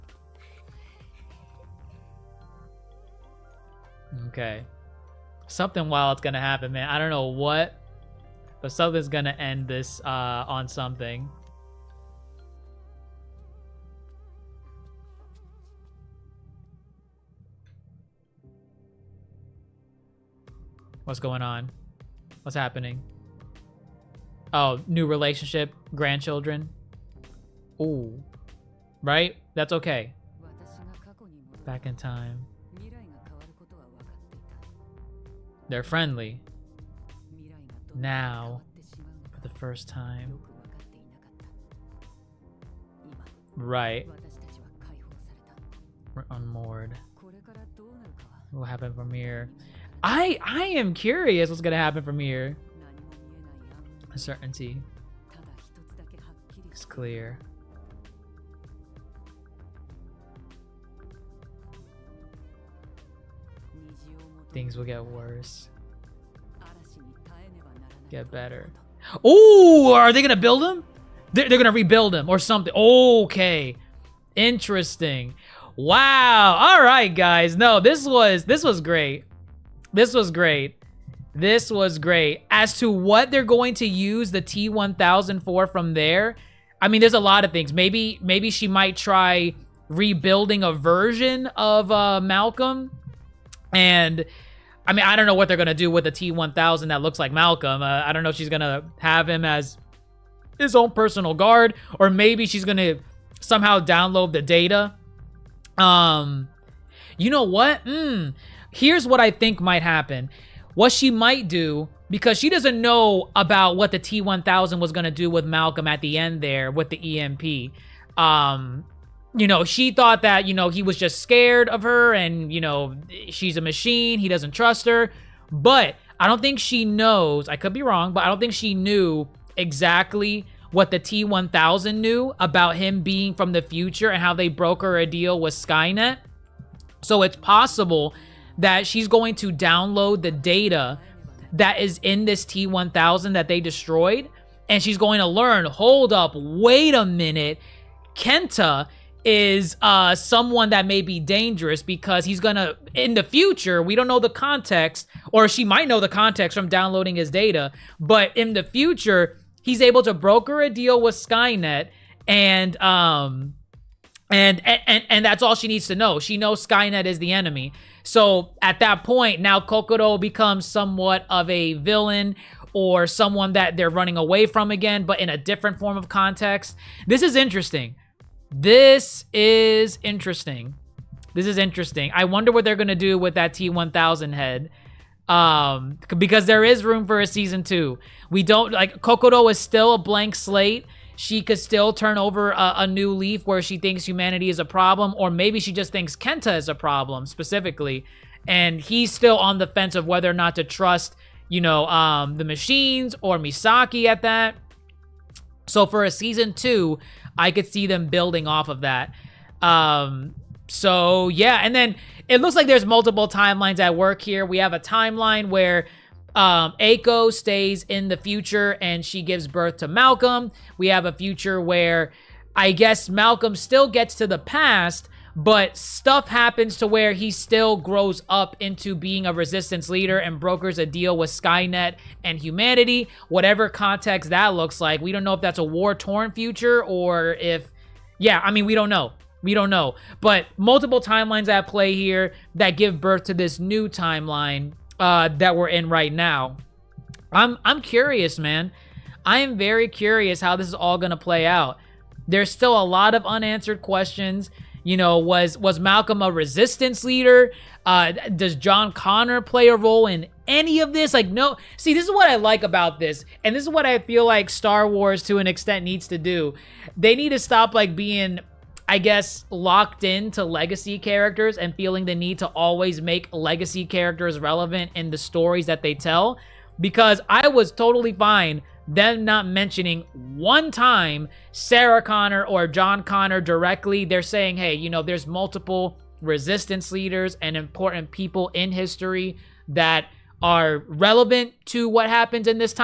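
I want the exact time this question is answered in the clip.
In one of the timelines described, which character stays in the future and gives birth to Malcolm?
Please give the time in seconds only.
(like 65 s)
216 s.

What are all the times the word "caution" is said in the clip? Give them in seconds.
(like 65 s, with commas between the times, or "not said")
not said.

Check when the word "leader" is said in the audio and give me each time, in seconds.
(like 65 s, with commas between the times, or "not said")
229 s, 257 s, 286 s.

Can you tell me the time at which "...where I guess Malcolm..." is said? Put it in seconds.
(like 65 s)
221 s.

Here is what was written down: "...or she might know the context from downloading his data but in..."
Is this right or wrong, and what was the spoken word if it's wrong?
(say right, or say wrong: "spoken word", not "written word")
right.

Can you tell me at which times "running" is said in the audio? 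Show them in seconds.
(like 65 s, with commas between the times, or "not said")
173 s.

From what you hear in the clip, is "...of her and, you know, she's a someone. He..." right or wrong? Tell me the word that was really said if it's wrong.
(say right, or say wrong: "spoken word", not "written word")
wrong: "machine", not "someone".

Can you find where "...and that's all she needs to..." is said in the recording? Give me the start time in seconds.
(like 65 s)
165 s.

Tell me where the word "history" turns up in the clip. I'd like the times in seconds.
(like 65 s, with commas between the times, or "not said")
288 s.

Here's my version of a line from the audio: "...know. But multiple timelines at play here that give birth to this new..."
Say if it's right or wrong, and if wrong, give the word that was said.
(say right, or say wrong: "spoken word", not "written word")
right.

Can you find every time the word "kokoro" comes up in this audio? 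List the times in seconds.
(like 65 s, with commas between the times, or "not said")
169 s, 189 s.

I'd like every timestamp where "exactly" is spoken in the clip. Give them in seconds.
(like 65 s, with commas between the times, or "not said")
129 s.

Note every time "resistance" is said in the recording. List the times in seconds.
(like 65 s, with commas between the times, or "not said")
229 s, 256 s, 286 s.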